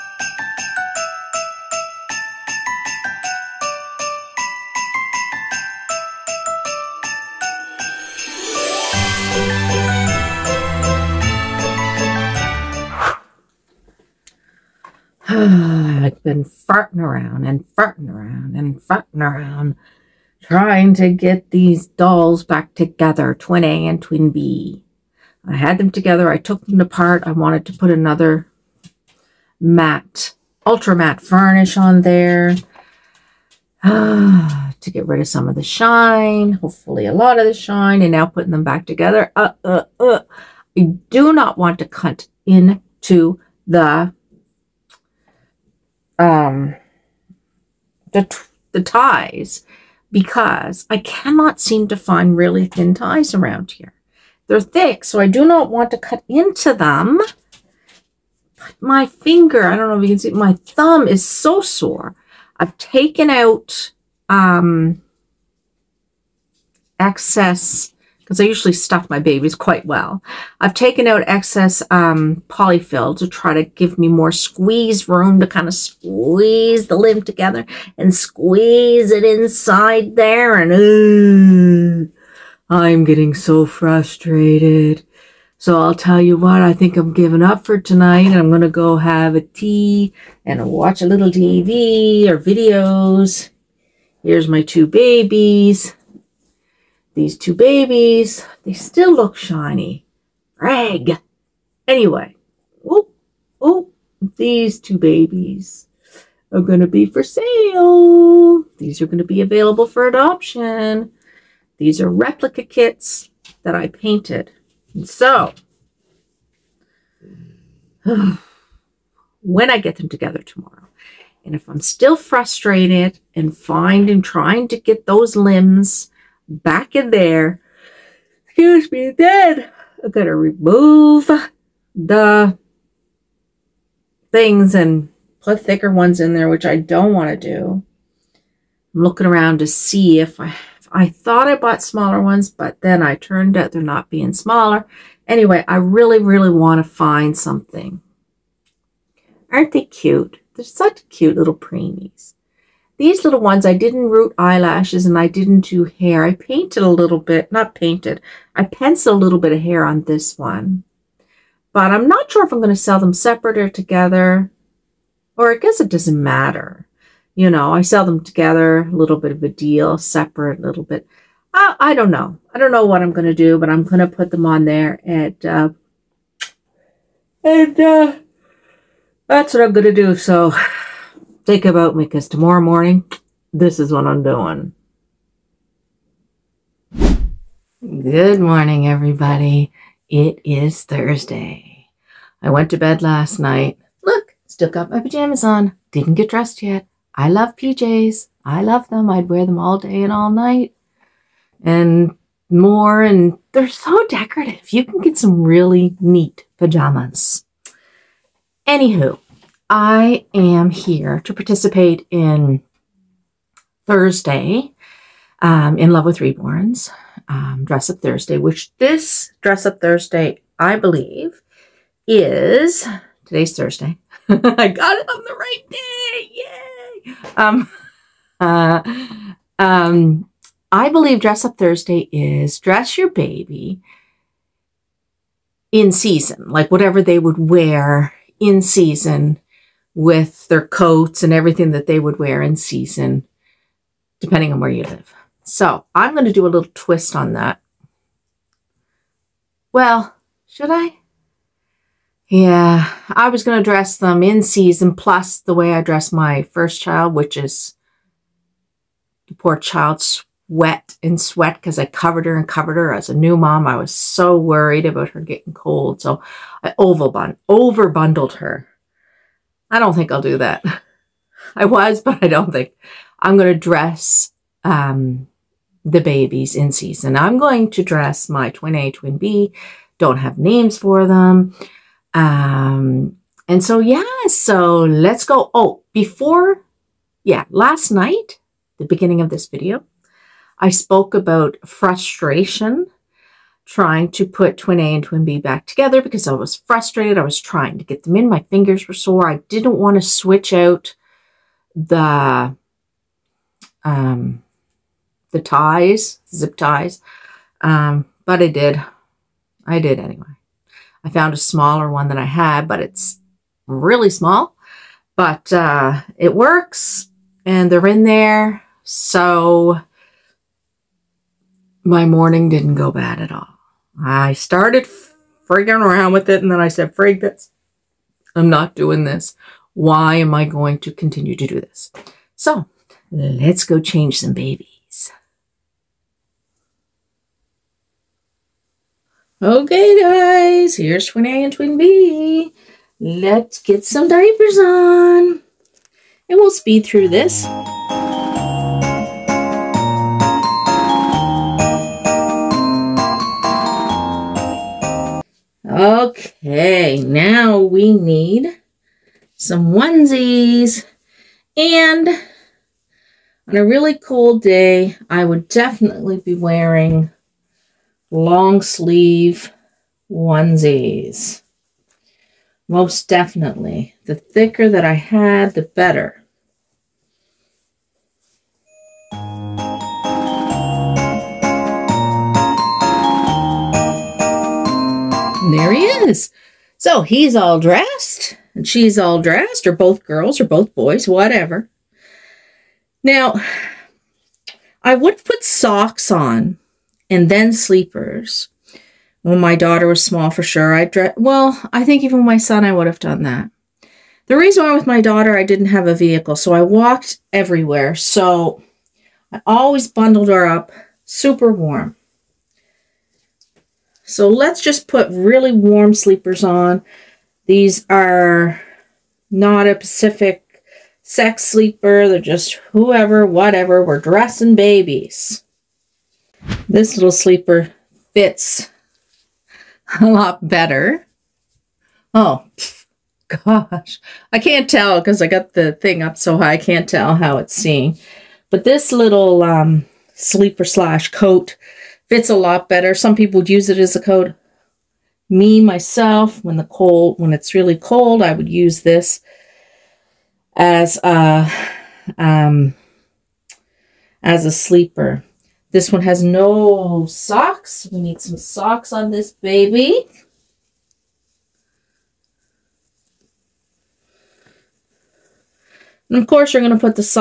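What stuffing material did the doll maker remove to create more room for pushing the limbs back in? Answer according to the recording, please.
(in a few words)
Polyfill.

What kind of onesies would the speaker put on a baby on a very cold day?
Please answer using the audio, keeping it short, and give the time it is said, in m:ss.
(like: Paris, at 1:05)
Long sleeve onesies, at 6:08.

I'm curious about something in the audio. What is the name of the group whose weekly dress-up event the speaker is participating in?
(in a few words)
Love with Reborns.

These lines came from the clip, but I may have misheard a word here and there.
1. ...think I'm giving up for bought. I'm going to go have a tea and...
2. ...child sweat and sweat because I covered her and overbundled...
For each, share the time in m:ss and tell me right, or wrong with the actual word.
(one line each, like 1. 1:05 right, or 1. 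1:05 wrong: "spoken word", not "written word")
1. 1:26 wrong: "tonight", not "bought"
2. 4:19 wrong: "covered", not "overbundled".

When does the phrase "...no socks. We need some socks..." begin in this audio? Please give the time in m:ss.
7:36.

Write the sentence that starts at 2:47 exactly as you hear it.
You know, I sell them together, a little bit of a deal, separate, a little bit.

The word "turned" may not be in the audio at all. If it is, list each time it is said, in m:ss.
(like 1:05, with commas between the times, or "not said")
2:23.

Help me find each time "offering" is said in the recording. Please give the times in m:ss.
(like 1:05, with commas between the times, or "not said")
not said.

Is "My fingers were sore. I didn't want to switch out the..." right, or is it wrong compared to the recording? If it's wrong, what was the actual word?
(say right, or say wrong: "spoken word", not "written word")
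right.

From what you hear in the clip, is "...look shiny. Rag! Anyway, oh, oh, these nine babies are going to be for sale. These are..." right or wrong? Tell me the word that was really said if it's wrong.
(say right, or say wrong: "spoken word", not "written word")
wrong: "two", not "nine".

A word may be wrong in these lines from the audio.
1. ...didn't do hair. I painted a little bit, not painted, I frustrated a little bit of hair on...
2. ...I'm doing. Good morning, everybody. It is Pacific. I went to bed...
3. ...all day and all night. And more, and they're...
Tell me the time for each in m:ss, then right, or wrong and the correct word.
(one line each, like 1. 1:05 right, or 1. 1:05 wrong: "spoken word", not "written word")
1. 2:35 wrong: "penciled", not "frustrated"
2. 3:04 wrong: "Thursday", not "Pacific"
3. 3:19 right.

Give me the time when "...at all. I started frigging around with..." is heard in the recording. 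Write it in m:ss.
5:23.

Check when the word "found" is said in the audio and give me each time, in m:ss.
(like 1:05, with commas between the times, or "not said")
5:11.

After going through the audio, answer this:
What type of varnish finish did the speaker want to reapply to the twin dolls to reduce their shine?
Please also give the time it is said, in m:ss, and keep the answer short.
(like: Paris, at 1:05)
Ultra matte, at 0:30.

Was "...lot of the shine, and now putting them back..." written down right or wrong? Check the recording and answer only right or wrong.
right.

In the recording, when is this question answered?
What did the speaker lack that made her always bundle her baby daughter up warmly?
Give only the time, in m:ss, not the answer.
6:45.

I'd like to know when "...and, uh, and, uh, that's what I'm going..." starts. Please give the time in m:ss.
2:55.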